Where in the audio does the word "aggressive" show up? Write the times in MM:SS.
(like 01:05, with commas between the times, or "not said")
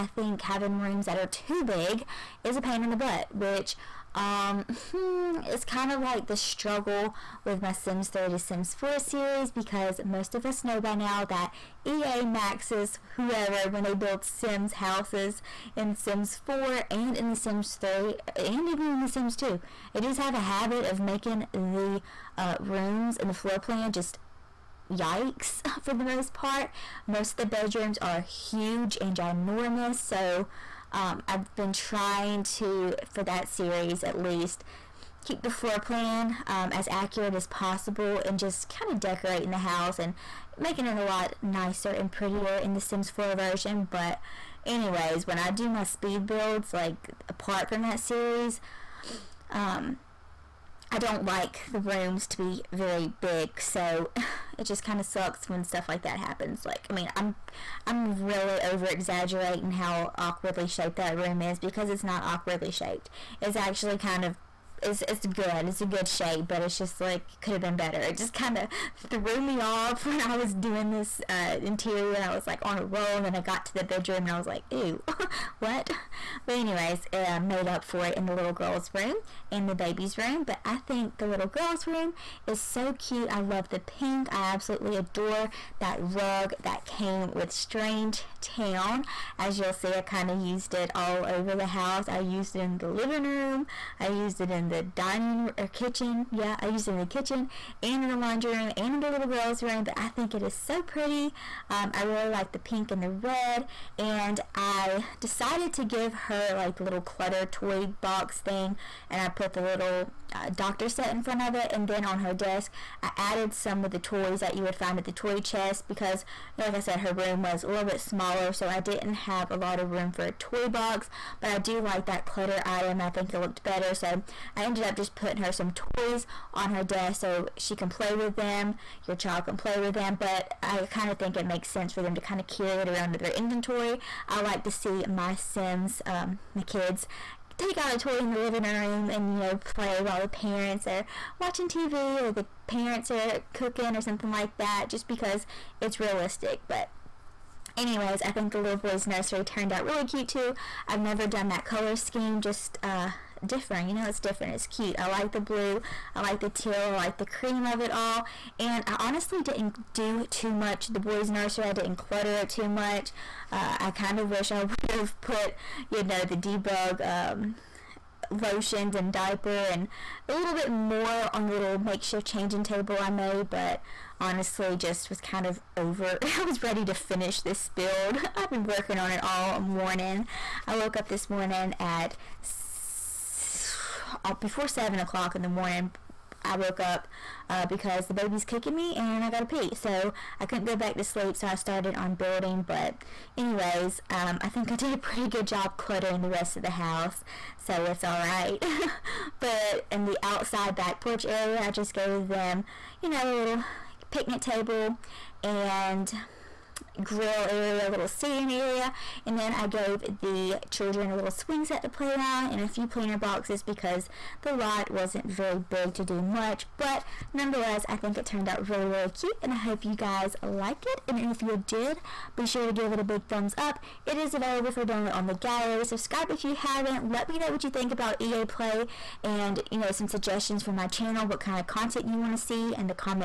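not said.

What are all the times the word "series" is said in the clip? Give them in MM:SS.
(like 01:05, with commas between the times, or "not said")
00:08, 00:33, 00:47.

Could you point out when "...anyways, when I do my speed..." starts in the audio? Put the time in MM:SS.
00:44.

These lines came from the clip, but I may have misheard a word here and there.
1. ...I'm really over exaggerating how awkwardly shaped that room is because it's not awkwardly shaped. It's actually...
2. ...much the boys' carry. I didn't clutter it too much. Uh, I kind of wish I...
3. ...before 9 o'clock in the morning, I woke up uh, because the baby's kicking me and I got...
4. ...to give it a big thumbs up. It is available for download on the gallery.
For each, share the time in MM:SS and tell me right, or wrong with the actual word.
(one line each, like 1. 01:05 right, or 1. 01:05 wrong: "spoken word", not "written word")
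1. 00:57 right
2. 02:40 wrong: "nursery", not "carry"
3. 03:04 wrong: "7", not "9"
4. 03:42 right.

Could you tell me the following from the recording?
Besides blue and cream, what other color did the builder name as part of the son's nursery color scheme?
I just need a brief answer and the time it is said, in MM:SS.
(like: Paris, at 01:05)
Teal, at 02:36.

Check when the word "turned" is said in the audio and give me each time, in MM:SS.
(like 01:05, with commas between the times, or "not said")
02:29, 03:38.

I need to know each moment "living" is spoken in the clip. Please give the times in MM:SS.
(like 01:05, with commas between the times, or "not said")
01:32, 02:18.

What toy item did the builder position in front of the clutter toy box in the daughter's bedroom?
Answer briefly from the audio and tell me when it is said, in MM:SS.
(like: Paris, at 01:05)
Doctor set, at 01:50.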